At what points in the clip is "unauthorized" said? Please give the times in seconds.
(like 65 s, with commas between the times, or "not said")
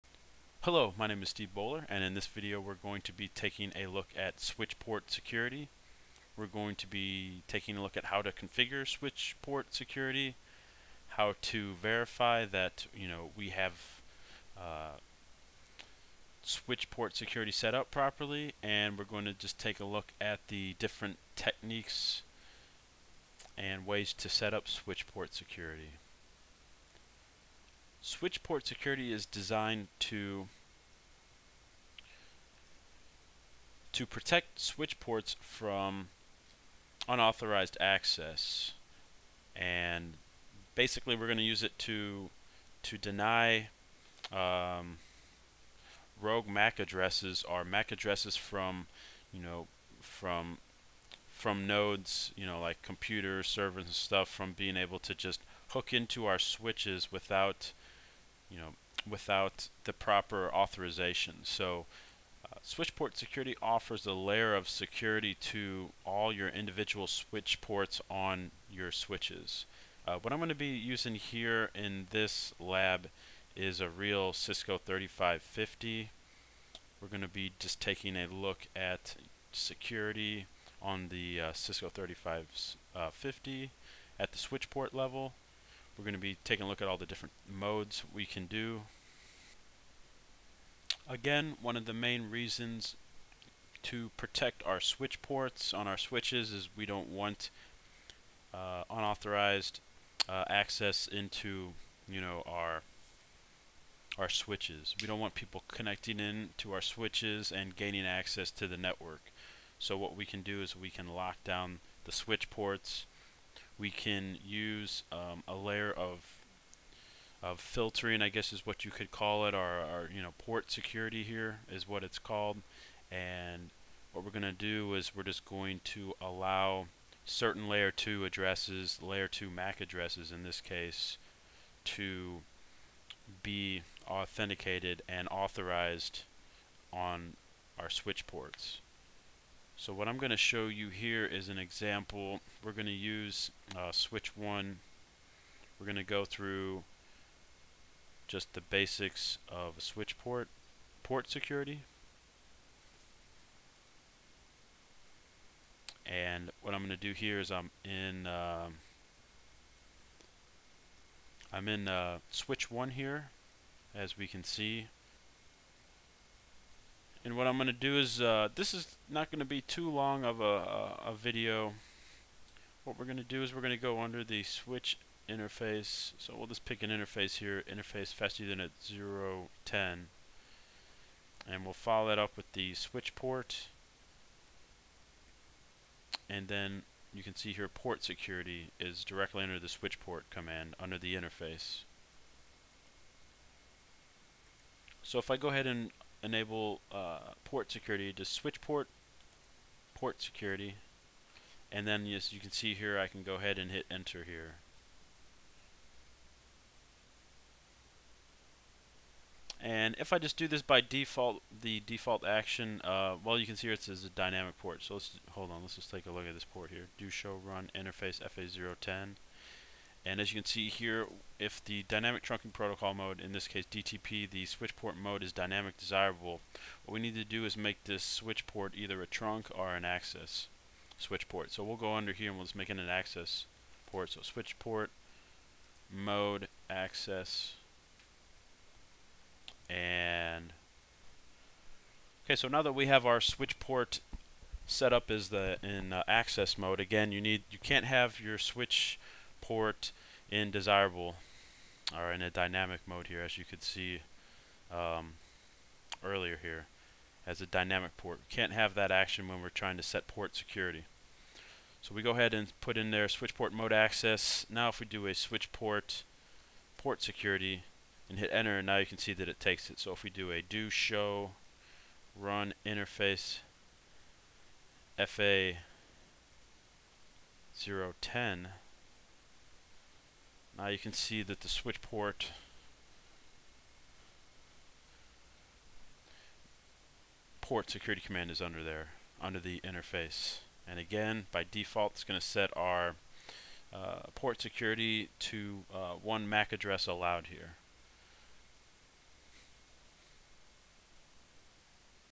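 37 s, 98 s.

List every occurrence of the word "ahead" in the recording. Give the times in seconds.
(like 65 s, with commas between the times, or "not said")
195 s, 203 s, 262 s.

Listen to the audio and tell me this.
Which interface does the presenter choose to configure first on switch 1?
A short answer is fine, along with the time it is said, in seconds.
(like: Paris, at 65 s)
fast 0 010, at 178 s.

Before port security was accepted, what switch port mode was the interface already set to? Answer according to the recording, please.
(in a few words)
dynamic desirable.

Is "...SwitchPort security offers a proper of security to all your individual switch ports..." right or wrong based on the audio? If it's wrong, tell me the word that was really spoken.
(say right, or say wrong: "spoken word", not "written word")
wrong: "layer", not "proper".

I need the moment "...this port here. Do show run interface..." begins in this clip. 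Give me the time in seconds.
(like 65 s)
216 s.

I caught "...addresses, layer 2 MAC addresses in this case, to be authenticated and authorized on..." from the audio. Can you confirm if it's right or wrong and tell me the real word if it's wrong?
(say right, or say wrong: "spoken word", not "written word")
right.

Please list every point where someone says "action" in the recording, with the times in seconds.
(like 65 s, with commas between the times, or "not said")
212 s, 258 s.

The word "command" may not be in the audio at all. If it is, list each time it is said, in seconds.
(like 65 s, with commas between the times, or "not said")
190 s, 288 s.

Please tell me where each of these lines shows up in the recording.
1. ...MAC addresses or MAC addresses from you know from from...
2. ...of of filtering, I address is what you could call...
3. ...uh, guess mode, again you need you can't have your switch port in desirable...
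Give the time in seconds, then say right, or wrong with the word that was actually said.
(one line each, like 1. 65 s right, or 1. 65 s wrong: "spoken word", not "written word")
1. 46 s right
2. 115 s wrong: "guess", not "address"
3. 245 s wrong: "access", not "guess".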